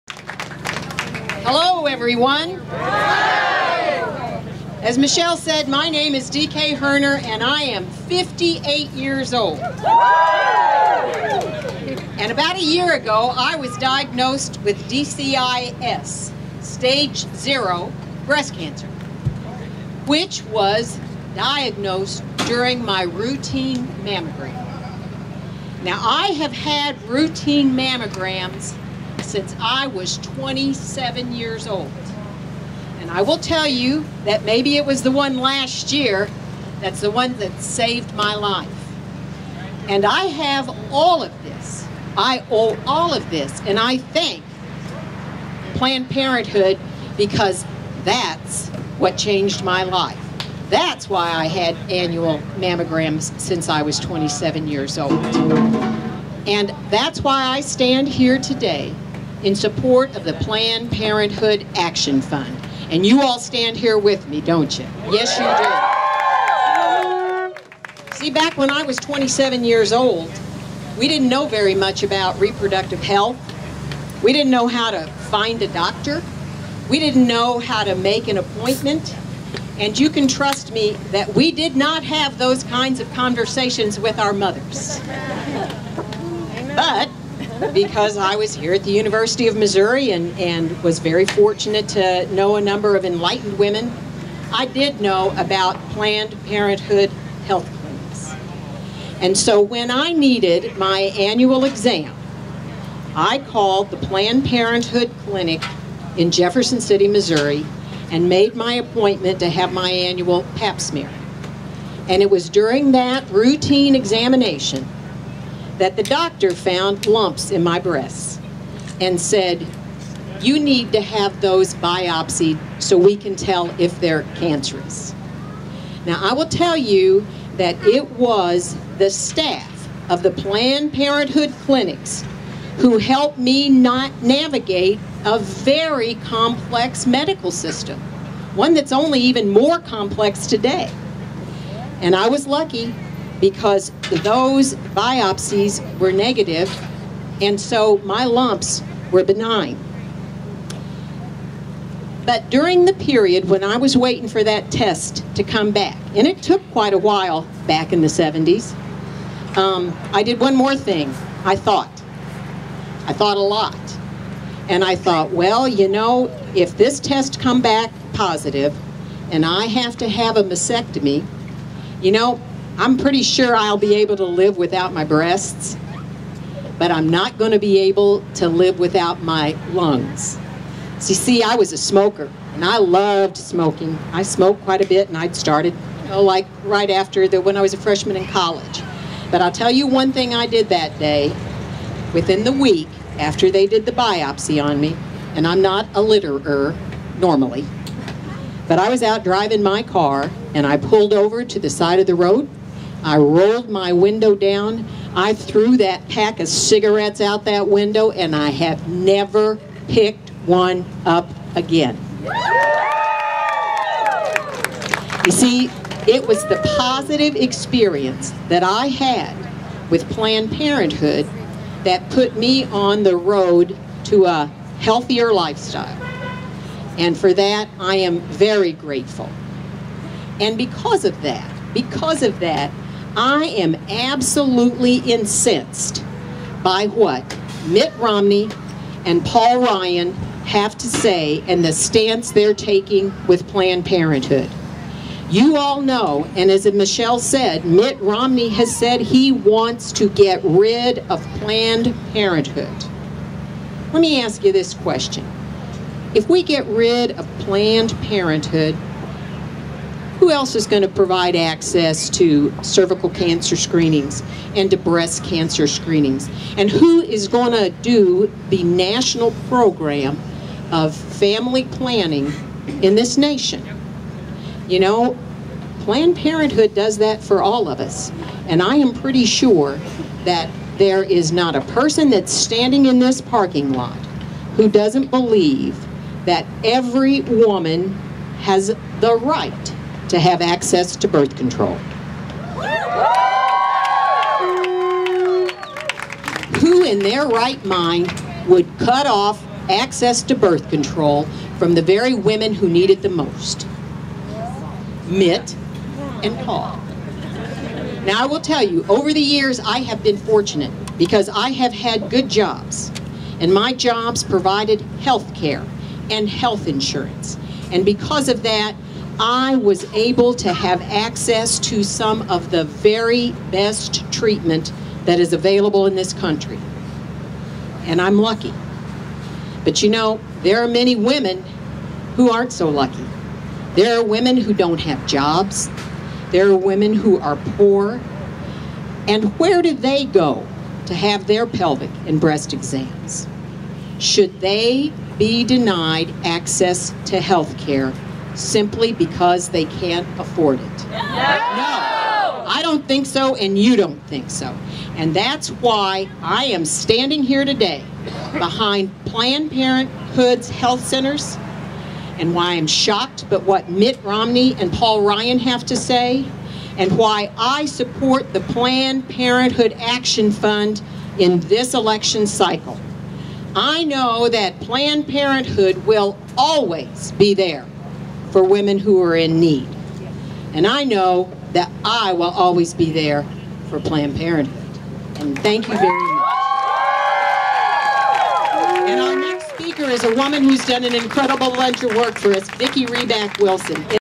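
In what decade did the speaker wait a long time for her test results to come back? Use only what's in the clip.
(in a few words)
the 70s.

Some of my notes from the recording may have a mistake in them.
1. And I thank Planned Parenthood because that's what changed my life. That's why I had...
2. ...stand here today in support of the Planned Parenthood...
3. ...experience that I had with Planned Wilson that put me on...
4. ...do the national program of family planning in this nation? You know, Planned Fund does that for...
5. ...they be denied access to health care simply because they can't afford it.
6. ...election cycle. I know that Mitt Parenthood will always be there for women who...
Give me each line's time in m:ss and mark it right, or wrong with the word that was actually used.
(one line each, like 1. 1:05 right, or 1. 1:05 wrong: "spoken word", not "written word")
1. 0:43 right
2. 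0:57 right
3. 3:37 wrong: "Parenthood", not "Wilson"
4. 4:27 wrong: "Parenthood", not "Fund"
5. 5:44 right
6. 6:11 wrong: "Planned", not "Mitt".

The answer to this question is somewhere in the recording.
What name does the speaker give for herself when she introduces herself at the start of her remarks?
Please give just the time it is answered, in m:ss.
0:06.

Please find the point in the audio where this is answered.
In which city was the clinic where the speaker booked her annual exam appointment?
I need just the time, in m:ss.
1:46.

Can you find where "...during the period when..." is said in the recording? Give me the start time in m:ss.
2:32.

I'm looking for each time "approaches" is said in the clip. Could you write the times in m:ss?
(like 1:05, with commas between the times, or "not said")
not said.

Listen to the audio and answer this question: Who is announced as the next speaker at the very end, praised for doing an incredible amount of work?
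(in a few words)
Vicki Riback Wilson.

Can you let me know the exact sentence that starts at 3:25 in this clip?
I threw that pack of cigarettes out that window, and I have never picked one up again.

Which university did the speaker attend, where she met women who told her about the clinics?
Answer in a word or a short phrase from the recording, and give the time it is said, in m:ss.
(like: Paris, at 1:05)
University of Missouri, at 1:28.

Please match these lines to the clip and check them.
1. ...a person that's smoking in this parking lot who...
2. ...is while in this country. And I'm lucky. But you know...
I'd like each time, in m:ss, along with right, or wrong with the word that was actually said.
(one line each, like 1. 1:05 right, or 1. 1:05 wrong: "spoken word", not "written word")
1. 4:41 wrong: "standing", not "smoking"
2. 5:25 wrong: "available", not "while".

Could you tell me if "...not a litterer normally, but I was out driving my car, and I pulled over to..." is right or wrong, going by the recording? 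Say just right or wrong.
right.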